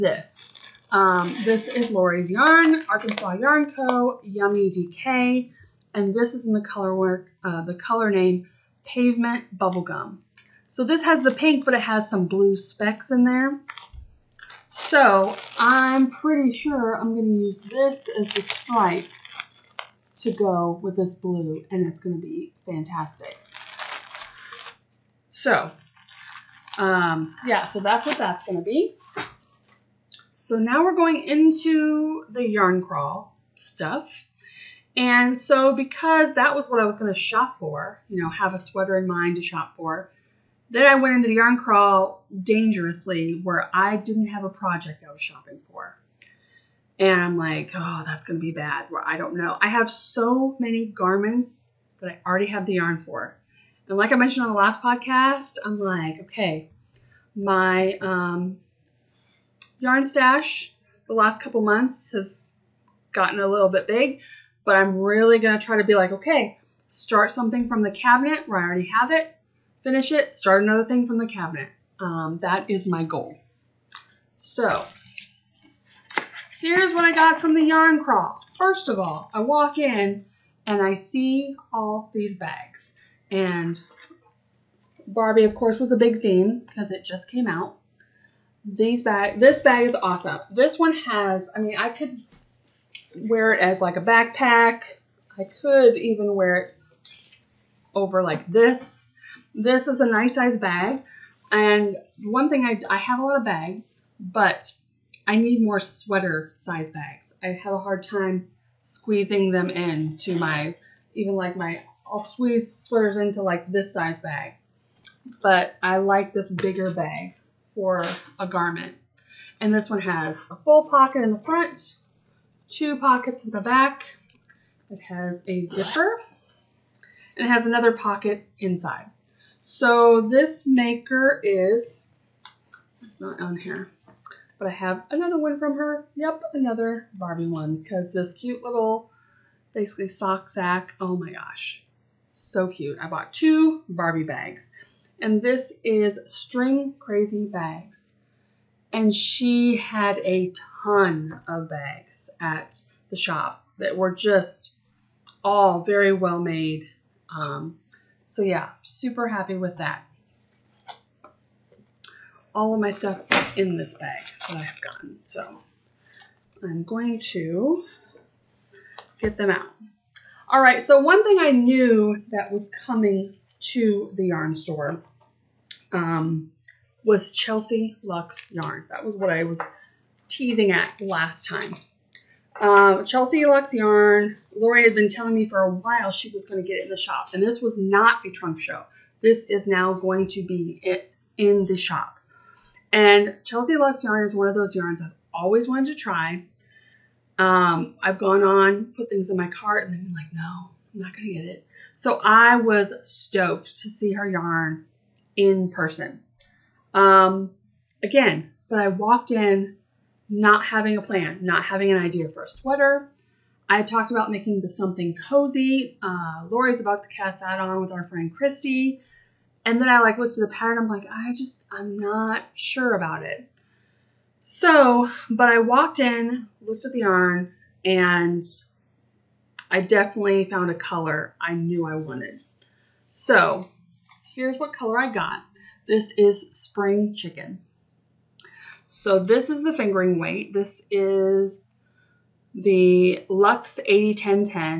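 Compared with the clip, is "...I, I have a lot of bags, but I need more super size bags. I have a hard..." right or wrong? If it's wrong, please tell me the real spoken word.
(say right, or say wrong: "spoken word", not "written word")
wrong: "sweater", not "super".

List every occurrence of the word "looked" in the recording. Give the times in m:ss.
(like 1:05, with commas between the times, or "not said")
3:40, 3:46.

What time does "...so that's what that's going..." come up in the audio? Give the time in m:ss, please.
0:27.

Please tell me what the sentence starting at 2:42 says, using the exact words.
All of my stuff is in this bag that I have gotten.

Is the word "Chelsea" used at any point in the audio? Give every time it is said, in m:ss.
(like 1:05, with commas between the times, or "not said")
2:57, 3:03, 3:13.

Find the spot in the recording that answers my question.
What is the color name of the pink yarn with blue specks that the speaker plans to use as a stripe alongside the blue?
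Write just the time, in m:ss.
0:08.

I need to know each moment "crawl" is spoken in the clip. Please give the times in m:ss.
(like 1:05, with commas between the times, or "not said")
0:32, 0:41, 1:18.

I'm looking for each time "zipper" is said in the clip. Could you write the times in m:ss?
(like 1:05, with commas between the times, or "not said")
2:05.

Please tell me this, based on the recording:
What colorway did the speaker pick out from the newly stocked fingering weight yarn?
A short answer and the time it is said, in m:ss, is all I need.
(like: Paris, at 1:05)
Spring Chicken, at 3:56.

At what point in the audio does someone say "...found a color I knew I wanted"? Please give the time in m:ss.
3:50.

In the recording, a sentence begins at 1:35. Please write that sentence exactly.
I could even wear it over like this.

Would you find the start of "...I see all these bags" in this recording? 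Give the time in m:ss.
1:20.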